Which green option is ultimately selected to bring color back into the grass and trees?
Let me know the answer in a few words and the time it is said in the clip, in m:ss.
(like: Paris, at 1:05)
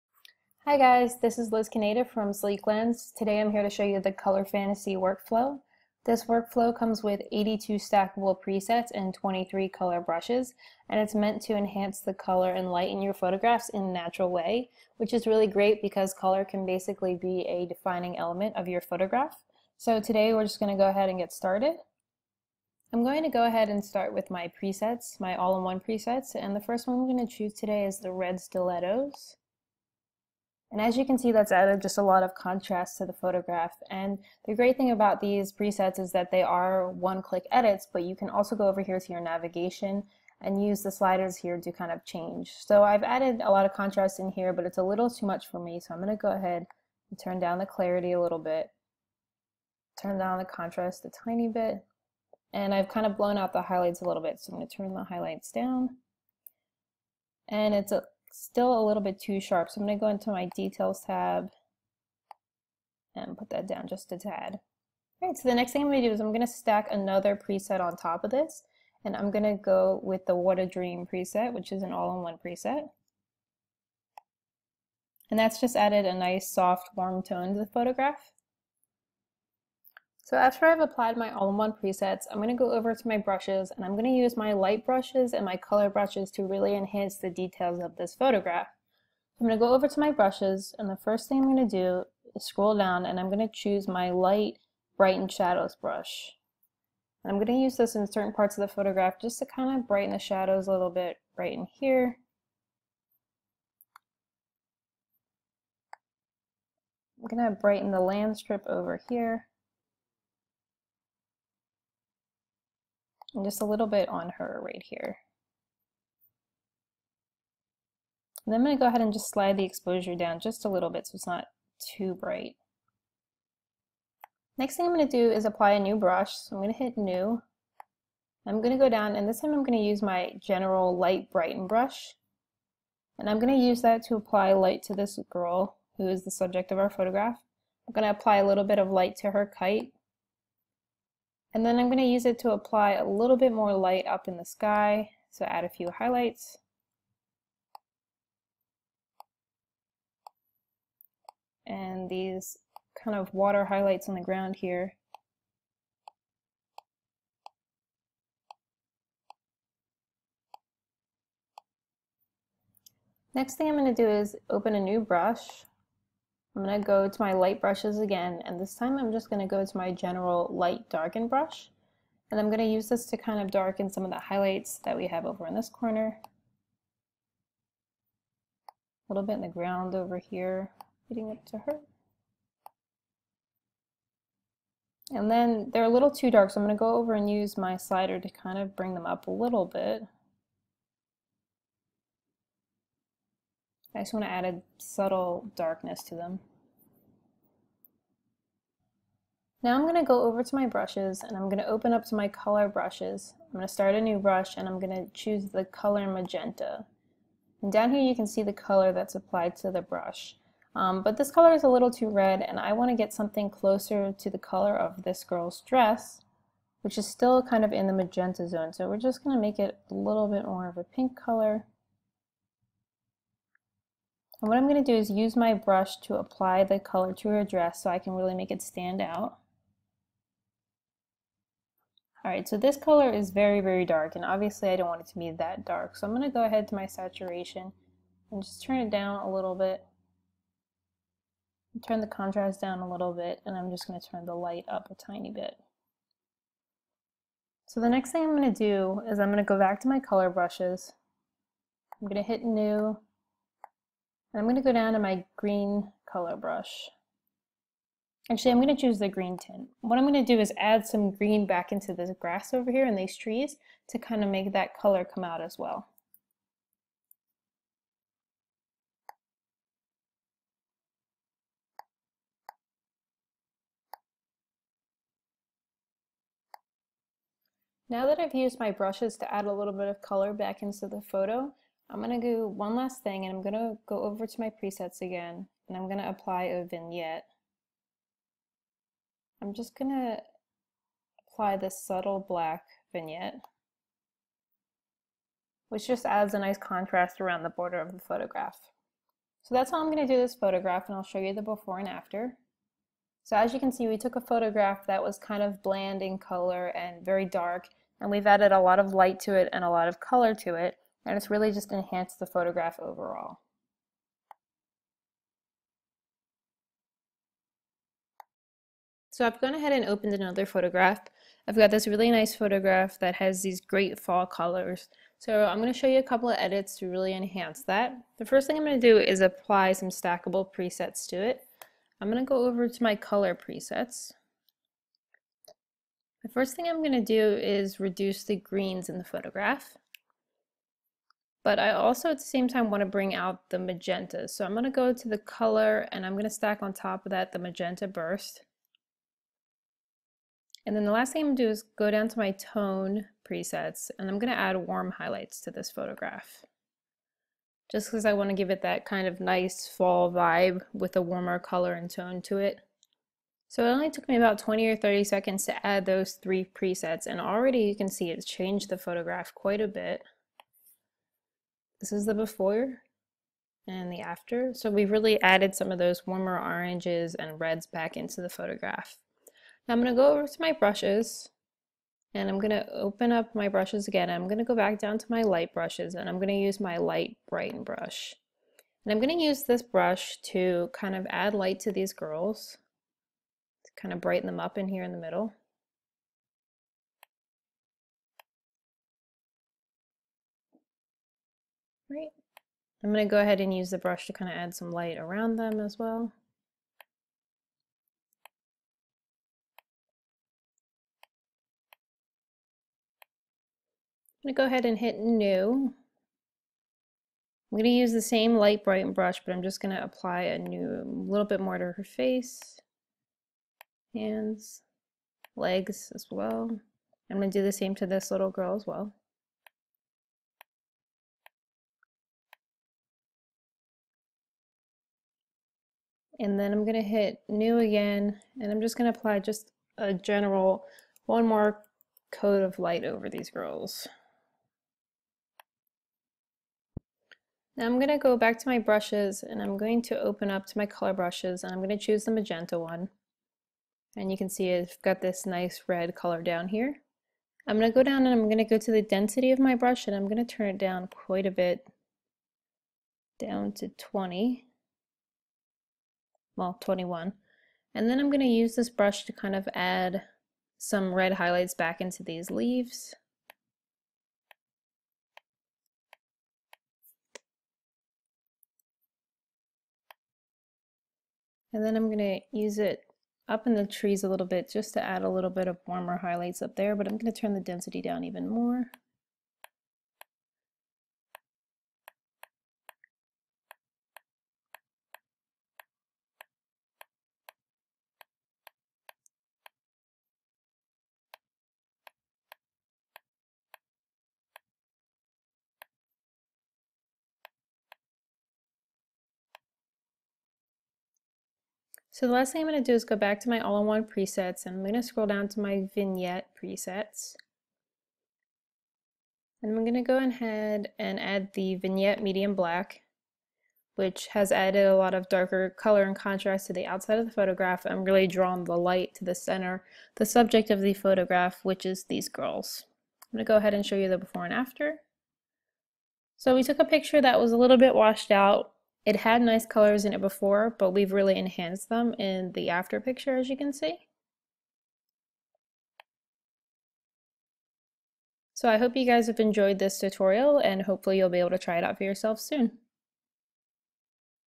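Green tint, at 4:19.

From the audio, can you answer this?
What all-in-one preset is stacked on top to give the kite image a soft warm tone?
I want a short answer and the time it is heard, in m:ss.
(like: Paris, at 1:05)
What a Dream, at 1:10.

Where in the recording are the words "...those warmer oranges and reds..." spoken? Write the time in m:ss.
6:15.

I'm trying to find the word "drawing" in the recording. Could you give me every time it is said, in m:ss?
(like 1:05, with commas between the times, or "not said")
8:48.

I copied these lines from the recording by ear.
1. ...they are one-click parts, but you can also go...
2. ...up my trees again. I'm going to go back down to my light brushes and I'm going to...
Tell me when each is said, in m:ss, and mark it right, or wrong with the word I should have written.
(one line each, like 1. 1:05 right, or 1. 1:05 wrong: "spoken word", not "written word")
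1. 0:36 wrong: "edits", not "parts"
2. 6:23 wrong: "brushes", not "trees".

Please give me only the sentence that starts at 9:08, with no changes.
So I hope you guys have enjoyed this tutorial and hopefully you'll be able to try it out for yourself soon.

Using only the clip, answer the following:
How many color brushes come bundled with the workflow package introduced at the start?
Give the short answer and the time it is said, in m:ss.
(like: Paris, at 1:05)
23, at 0:09.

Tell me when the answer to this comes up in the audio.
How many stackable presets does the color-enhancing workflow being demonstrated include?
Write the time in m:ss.
0:07.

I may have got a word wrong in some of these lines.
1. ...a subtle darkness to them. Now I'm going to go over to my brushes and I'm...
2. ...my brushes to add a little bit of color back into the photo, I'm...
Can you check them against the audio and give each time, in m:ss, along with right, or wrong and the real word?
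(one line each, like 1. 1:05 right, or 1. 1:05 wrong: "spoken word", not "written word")
1. 3:14 right
2. 4:38 right.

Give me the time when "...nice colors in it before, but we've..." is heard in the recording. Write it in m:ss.
8:59.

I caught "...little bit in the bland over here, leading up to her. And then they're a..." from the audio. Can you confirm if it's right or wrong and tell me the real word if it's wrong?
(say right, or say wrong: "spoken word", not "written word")
wrong: "ground", not "bland".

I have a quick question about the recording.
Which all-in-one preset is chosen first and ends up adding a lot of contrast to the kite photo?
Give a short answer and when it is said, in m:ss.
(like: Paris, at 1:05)
Red Stilettos, at 0:28.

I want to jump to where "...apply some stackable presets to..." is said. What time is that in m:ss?
5:29.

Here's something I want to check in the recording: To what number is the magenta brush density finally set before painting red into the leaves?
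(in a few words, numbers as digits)
21.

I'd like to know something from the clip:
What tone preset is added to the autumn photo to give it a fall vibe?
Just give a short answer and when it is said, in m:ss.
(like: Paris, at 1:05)
Warm highlights, at 5:54.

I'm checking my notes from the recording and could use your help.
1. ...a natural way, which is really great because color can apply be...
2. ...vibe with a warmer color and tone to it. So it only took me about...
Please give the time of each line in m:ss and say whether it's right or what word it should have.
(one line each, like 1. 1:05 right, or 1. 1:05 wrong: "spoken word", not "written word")
1. 0:13 wrong: "basically", not "apply"
2. 6:00 right.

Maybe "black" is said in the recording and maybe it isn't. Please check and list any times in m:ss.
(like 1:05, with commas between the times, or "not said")
4:52, 8:42.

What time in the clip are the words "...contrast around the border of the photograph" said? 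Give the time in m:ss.
4:56.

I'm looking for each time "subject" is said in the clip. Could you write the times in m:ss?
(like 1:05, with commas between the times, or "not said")
2:16, 8:50.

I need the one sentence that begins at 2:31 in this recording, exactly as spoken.
And these kind of water highlights on the ground here.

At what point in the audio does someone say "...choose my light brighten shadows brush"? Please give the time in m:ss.
1:33.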